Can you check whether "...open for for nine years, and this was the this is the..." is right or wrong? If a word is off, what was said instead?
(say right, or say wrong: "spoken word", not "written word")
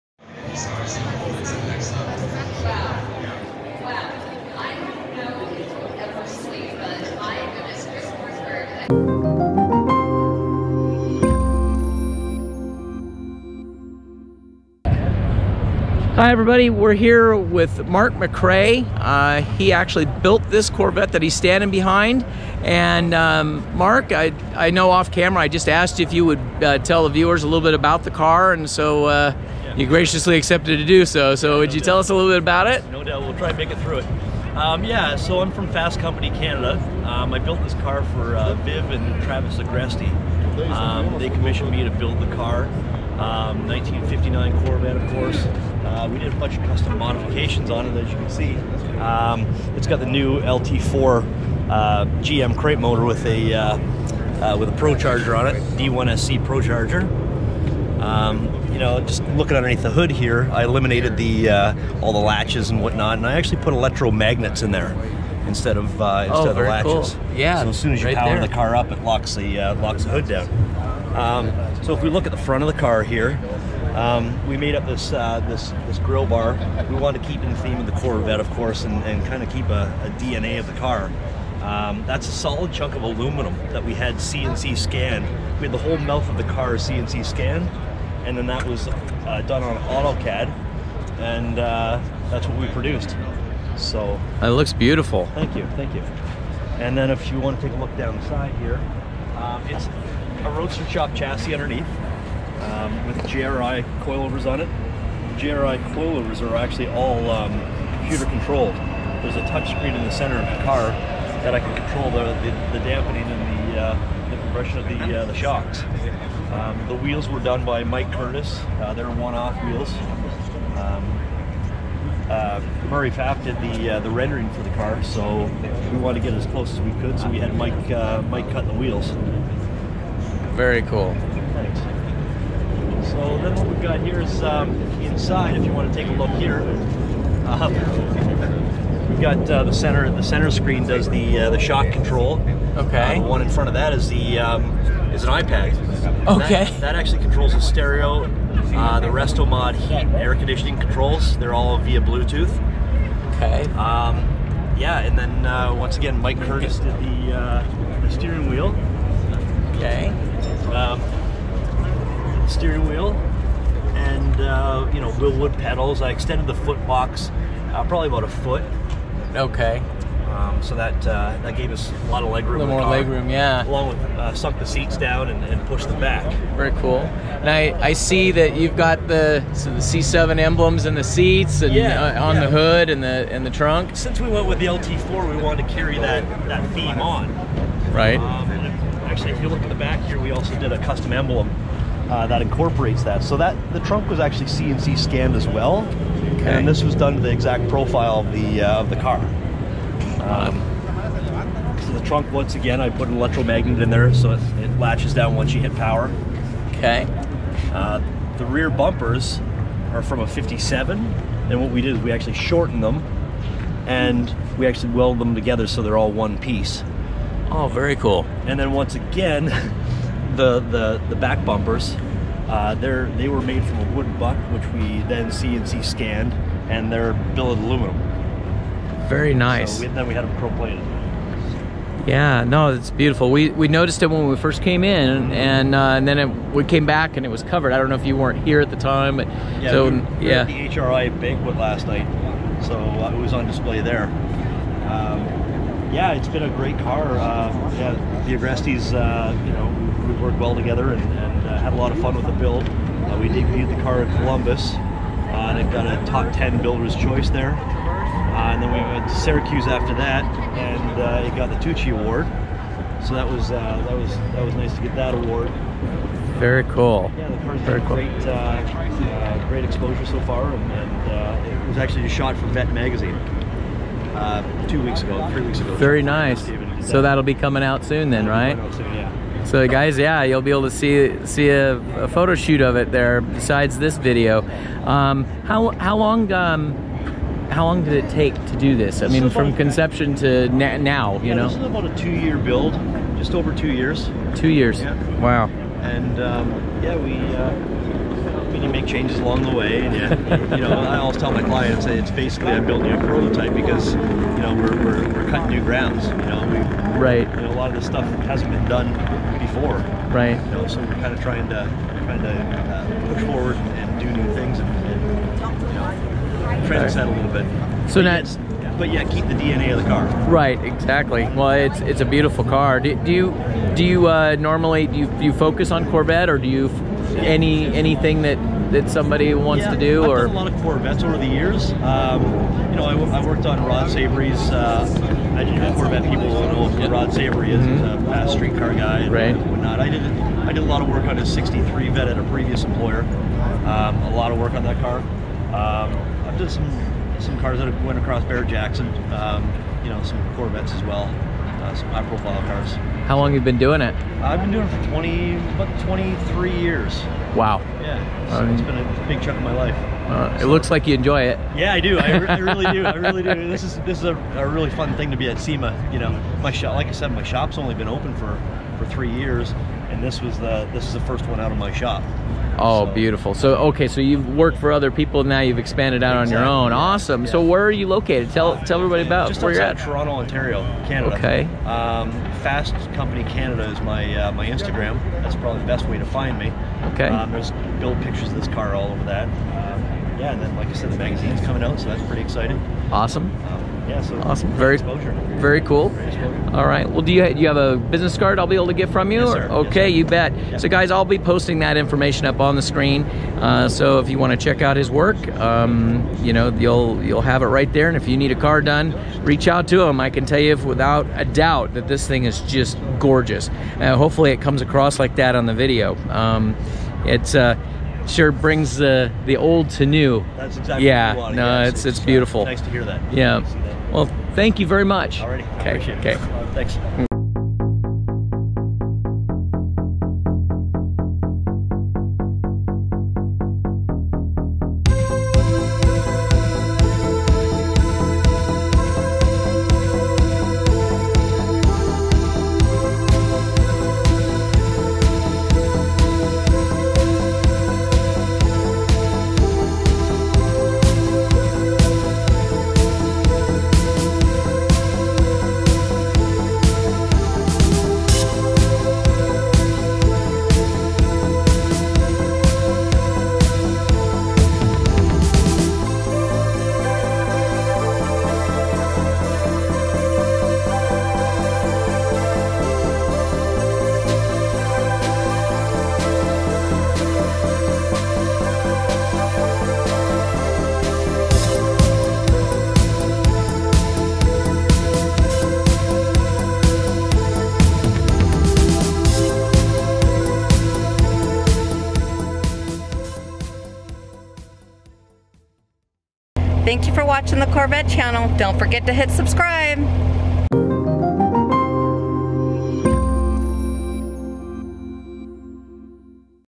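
wrong: "three", not "nine".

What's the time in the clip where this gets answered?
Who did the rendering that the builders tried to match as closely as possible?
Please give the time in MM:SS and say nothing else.
02:02.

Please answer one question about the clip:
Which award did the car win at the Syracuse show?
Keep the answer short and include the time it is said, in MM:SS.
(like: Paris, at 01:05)
Tucci Award, at 04:21.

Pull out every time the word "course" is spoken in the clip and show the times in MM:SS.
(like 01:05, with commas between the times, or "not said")
00:45, 01:18.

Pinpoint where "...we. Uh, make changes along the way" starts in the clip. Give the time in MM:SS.
04:56.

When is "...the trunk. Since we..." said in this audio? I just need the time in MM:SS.
03:03.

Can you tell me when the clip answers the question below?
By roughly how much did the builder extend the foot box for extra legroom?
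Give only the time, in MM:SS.
02:48.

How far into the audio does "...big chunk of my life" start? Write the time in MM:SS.
05:59.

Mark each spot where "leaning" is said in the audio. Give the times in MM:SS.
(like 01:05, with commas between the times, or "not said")
not said.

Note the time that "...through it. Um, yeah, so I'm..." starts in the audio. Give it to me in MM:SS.
00:33.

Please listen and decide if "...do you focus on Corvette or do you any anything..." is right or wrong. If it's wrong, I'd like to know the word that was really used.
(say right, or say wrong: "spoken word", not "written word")
right.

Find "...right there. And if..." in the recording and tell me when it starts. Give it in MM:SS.
06:47.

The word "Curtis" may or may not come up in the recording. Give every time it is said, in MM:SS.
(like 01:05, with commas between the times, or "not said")
01:58, 02:36.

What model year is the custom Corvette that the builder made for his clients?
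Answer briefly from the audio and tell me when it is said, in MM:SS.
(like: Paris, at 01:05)
1959, at 00:43.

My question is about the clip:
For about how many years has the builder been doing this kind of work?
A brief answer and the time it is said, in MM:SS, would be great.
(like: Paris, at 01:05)
23, at 05:55.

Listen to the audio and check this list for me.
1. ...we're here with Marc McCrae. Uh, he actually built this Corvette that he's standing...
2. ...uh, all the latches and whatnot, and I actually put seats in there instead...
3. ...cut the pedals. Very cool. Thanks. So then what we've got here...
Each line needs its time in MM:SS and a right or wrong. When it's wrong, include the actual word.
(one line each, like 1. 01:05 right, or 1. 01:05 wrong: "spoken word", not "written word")
1. 00:16 right
2. 01:01 wrong: "electromagnets", not "seats"
3. 02:08 wrong: "wheels", not "pedals".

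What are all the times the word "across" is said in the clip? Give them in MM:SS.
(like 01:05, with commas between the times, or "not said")
05:47, 06:54.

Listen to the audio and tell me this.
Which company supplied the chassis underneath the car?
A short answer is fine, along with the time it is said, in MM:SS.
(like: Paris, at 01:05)
Roadster Shop, at 01:40.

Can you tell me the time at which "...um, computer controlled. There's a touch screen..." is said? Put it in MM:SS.
01:47.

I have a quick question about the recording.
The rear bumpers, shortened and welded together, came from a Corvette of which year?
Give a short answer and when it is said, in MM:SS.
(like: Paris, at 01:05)
57, at 03:30.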